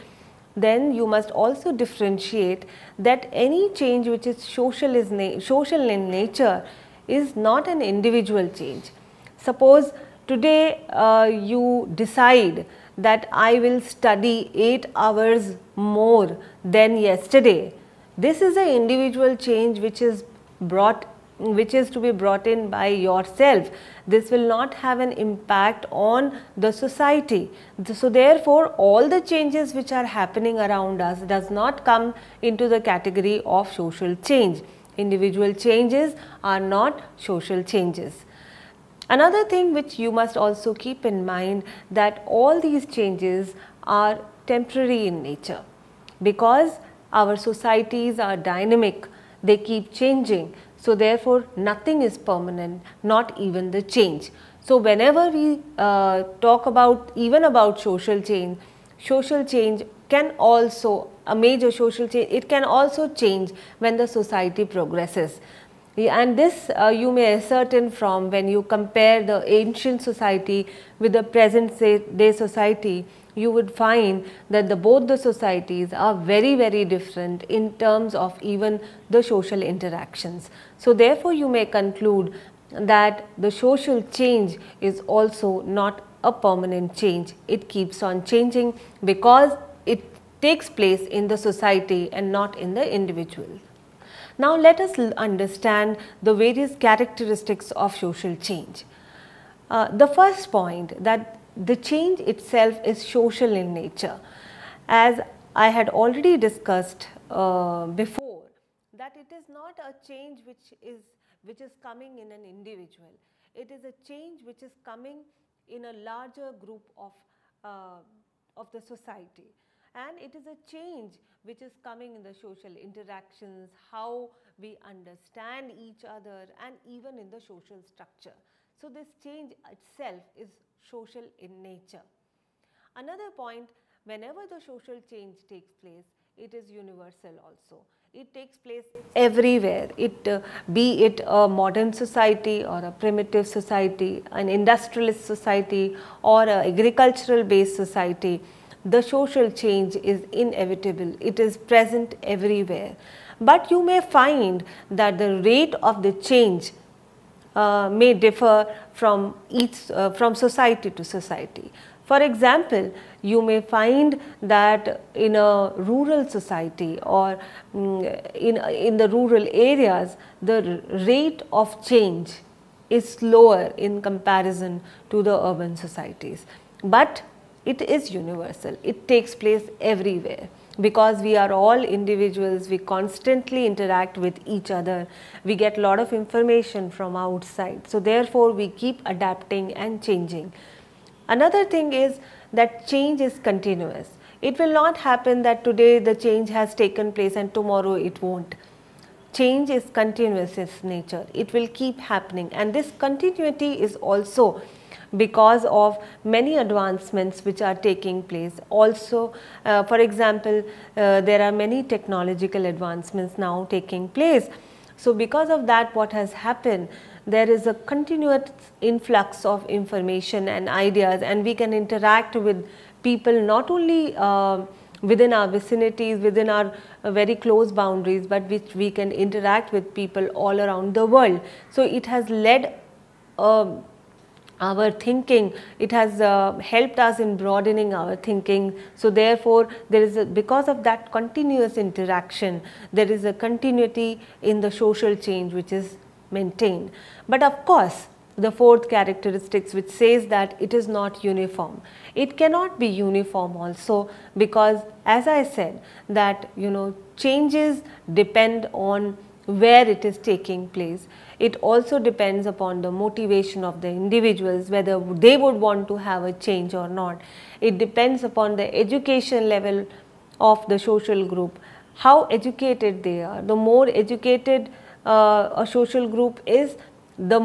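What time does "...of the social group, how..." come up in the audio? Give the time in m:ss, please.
4:30.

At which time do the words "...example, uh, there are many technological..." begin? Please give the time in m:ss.
3:29.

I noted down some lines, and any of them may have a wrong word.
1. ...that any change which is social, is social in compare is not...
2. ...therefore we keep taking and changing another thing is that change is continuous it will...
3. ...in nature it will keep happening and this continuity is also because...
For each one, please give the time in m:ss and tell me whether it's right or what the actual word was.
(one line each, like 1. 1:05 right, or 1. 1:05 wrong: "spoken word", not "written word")
1. 0:02 wrong: "nature", not "compare"
2. 3:07 wrong: "adapting", not "taking"
3. 3:20 right.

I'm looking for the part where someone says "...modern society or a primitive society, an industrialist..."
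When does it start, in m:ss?
2:21.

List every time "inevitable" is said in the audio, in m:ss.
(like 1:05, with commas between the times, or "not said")
2:30.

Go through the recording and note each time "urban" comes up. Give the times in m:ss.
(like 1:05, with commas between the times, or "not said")
2:55.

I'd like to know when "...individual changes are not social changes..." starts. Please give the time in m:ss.
0:34.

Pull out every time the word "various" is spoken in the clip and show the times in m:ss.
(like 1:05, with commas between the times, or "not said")
1:36.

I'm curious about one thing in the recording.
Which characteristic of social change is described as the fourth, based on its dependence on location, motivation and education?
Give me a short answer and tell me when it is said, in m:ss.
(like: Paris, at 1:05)
Not uniform, at 4:10.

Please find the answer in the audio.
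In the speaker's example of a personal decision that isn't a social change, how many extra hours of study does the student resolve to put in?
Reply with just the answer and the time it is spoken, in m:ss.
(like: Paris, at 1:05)
8, at 0:14.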